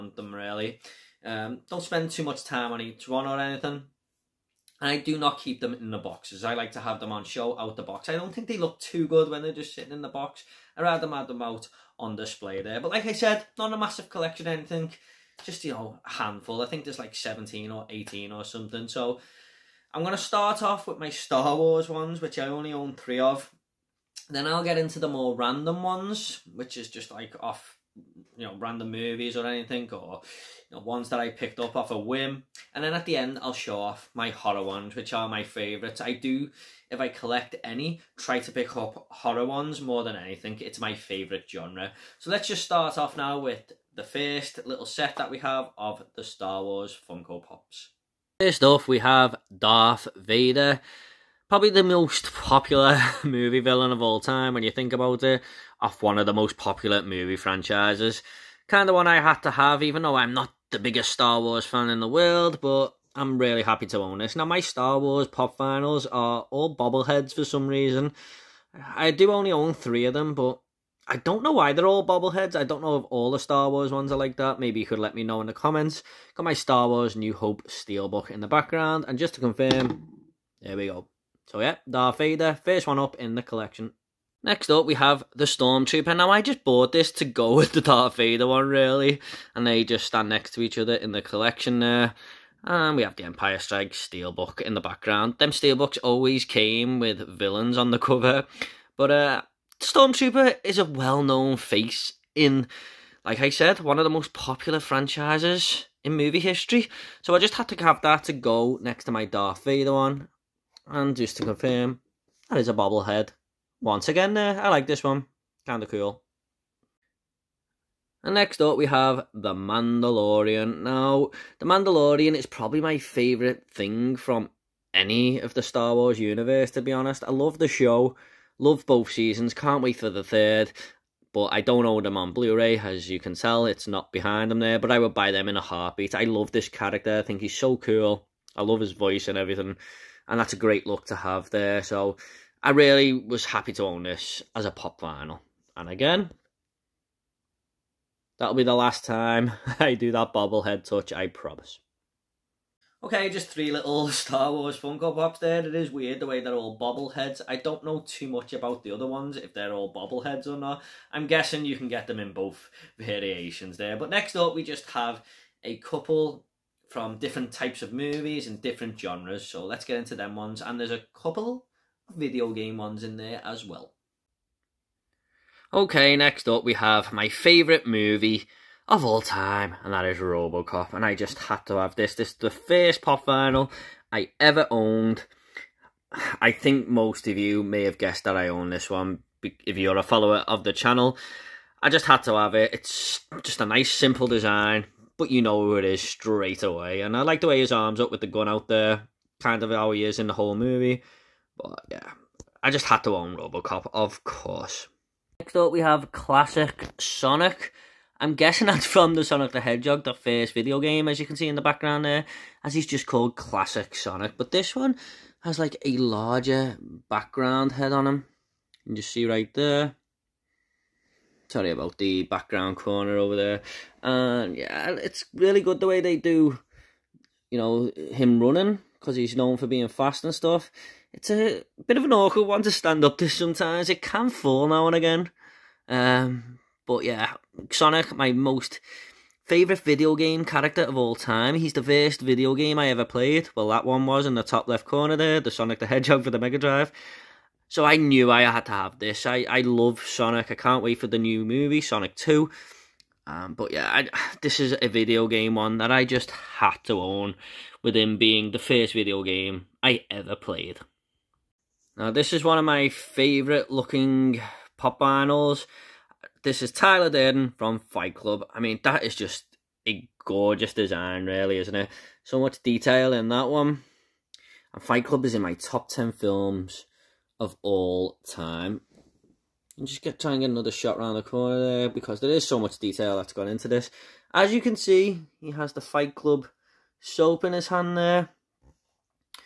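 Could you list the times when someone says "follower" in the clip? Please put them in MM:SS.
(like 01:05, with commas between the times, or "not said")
03:10.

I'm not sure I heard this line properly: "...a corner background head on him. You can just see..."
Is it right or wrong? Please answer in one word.
wrong.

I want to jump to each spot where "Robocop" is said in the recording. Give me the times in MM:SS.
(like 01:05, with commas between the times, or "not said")
03:00, 03:23.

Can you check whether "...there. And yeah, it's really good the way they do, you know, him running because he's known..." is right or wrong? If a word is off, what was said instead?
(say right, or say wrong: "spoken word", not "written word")
right.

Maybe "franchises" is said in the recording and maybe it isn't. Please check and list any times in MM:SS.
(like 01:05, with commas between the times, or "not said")
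00:57, 01:44.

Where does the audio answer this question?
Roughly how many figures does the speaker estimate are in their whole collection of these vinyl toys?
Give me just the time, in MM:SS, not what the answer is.
00:17.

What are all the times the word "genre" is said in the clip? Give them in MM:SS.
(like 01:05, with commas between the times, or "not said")
00:41, 02:48.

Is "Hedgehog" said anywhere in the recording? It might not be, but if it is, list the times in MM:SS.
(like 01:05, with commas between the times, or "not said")
03:29, 04:05.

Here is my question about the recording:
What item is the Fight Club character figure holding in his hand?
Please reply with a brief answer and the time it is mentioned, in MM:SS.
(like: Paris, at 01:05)
Fight Club soap, at 04:45.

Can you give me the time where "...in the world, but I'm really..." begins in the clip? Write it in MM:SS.
01:01.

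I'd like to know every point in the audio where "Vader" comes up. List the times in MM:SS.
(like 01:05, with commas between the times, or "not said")
00:50, 01:22, 01:28, 01:49.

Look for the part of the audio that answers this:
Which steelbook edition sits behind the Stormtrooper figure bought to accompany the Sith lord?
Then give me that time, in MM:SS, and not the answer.
01:33.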